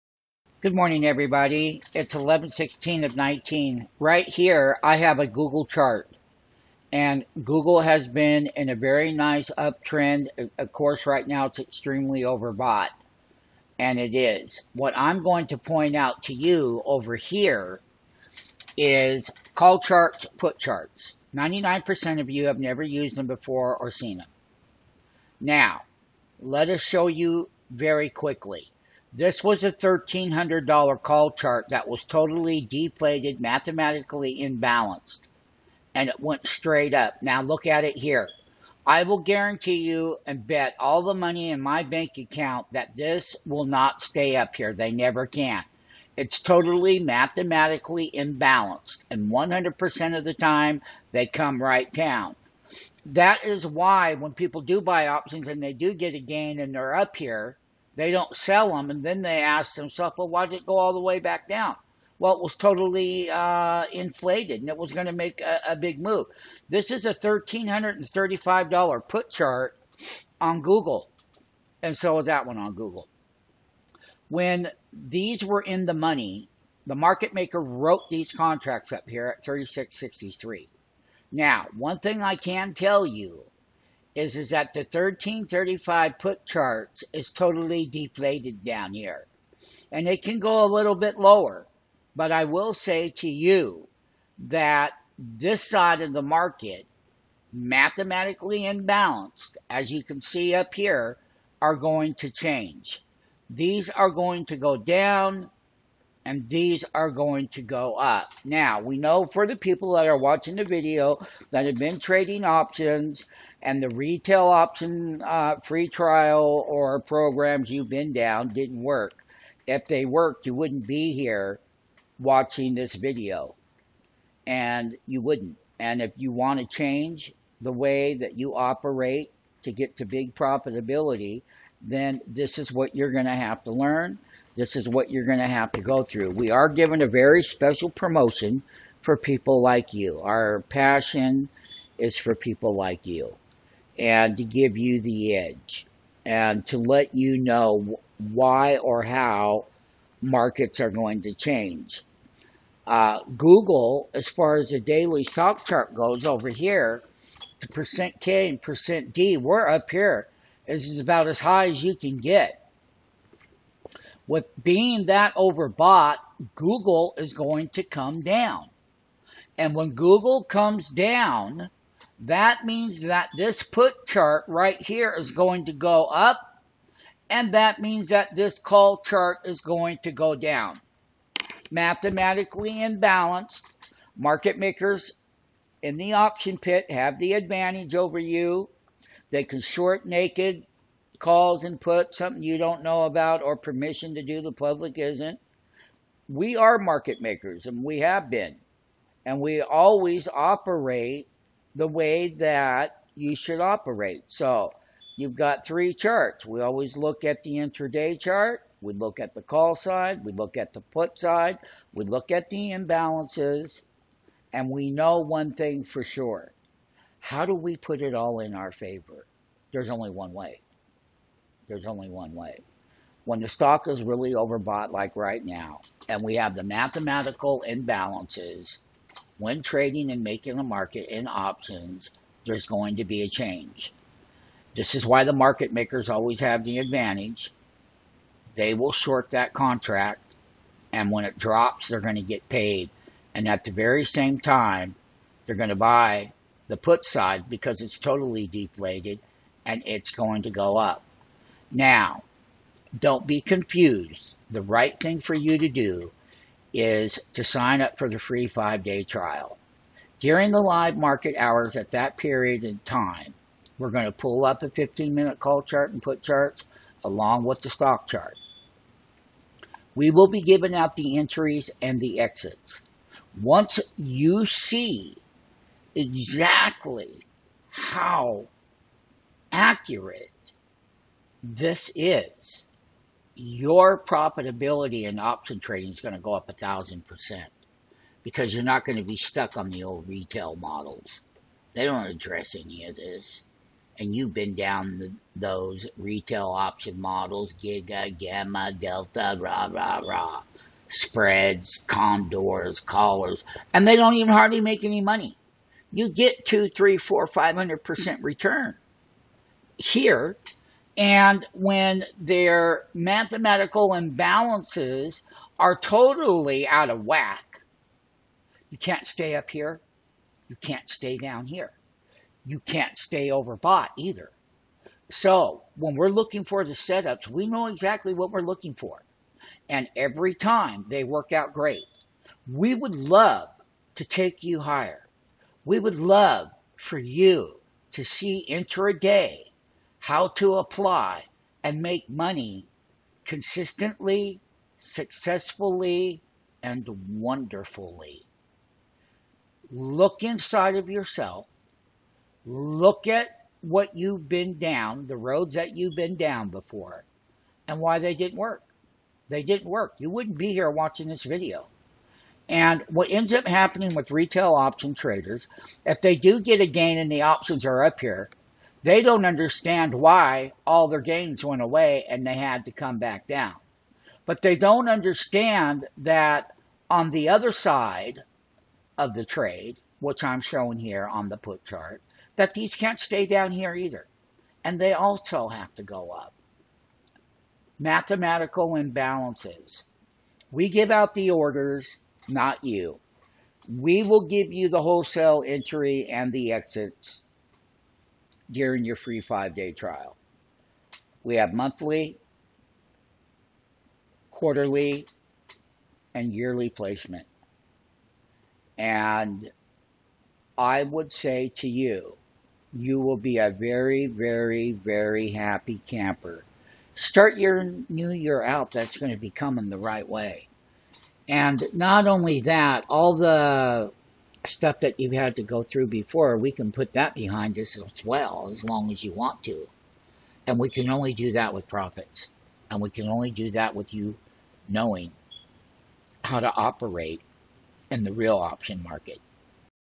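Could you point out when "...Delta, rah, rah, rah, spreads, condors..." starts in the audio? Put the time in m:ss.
4:58.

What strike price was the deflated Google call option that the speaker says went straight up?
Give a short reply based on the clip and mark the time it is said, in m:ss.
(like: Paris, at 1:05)
$1,300, at 0:29.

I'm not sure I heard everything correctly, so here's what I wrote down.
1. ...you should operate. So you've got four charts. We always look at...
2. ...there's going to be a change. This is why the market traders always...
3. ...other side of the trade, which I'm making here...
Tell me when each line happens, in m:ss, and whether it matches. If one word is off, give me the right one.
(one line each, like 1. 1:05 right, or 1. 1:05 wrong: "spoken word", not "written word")
1. 3:23 wrong: "three", not "four"
2. 3:52 wrong: "makers", not "traders"
3. 6:17 wrong: "showing", not "making".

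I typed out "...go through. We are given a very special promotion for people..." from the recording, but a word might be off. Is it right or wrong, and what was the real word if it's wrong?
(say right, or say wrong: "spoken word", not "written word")
right.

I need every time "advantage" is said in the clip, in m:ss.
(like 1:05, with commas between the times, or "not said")
3:07, 3:56.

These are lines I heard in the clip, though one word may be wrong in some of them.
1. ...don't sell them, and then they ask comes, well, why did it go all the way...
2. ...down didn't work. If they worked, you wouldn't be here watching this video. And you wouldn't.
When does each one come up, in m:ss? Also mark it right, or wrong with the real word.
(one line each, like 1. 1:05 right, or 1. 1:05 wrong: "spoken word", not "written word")
1. 0:58 wrong: "themselves", not "comes"
2. 1:58 right.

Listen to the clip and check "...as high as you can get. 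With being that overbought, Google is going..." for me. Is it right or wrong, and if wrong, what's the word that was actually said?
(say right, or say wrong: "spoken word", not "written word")
right.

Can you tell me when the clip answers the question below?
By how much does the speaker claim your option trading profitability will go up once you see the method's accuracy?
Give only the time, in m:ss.
4:46.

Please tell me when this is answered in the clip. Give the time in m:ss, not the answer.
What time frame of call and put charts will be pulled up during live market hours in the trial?
4:24.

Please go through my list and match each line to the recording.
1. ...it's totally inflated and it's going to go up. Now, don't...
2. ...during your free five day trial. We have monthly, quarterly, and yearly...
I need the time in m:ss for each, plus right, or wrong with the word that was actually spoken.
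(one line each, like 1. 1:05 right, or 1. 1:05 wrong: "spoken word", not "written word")
1. 4:07 wrong: "deflated", not "inflated"
2. 6:38 right.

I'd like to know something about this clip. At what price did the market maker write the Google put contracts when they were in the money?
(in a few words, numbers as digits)
36.63.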